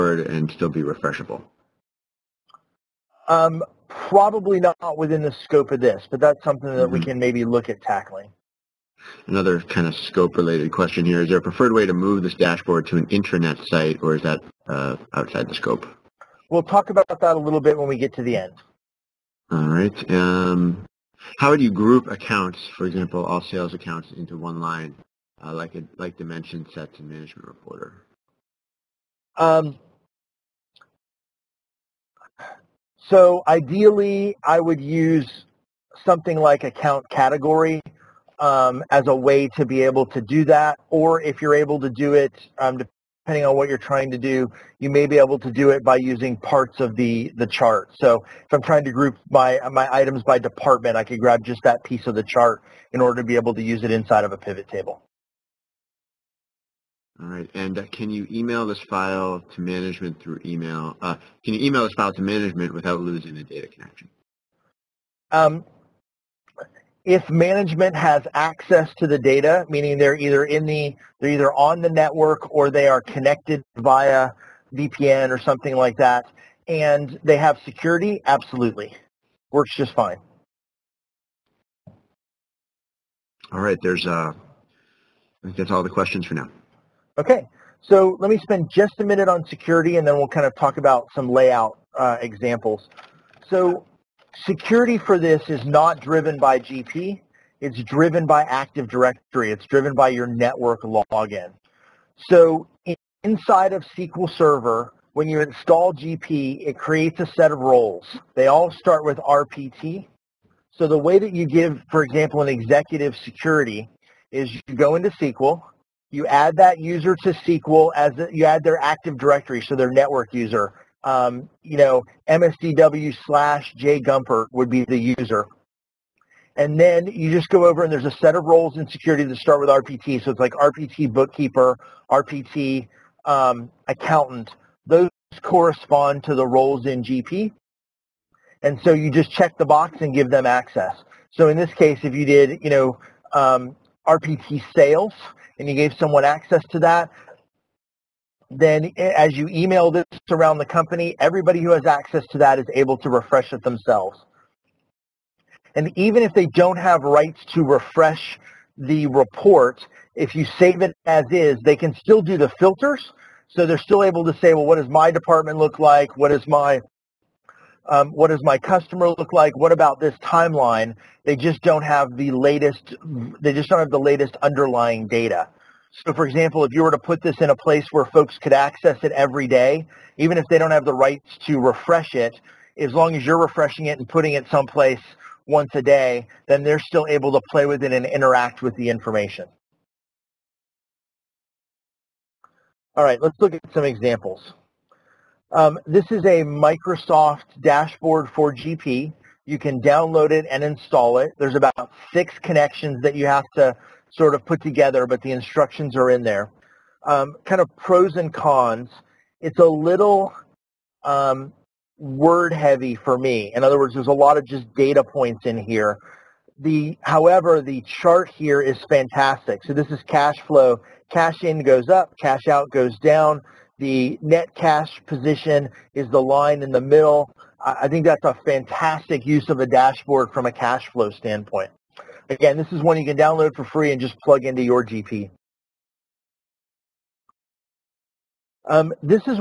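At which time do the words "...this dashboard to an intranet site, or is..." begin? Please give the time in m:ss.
0:12.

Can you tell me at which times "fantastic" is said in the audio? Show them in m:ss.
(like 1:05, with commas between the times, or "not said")
3:38, 3:48.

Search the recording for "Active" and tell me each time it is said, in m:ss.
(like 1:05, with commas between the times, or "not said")
1:38, 1:58.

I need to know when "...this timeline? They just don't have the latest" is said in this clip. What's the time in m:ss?
2:49.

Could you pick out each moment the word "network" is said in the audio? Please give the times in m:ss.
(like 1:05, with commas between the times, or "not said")
1:11, 1:40, 1:59.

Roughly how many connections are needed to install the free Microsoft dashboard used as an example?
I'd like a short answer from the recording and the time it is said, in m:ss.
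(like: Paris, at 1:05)
6, at 3:22.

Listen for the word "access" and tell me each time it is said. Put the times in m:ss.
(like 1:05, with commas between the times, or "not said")
1:08, 2:20, 2:26, 2:31, 2:58.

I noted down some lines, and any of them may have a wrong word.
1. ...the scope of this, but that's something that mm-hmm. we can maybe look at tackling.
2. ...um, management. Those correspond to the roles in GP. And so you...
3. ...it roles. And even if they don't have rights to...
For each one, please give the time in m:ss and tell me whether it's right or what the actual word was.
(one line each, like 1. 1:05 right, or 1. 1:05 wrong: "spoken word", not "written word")
1. 0:05 right
2. 2:13 wrong: "accountant", not "management"
3. 2:33 wrong: "themselves", not "roles".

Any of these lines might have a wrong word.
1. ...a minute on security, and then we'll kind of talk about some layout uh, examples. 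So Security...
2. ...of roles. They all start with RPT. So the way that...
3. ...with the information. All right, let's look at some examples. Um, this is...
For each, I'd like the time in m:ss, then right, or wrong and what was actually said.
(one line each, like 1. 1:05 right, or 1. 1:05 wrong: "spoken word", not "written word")
1. 1:28 right
2. 1:47 right
3. 3:08 right.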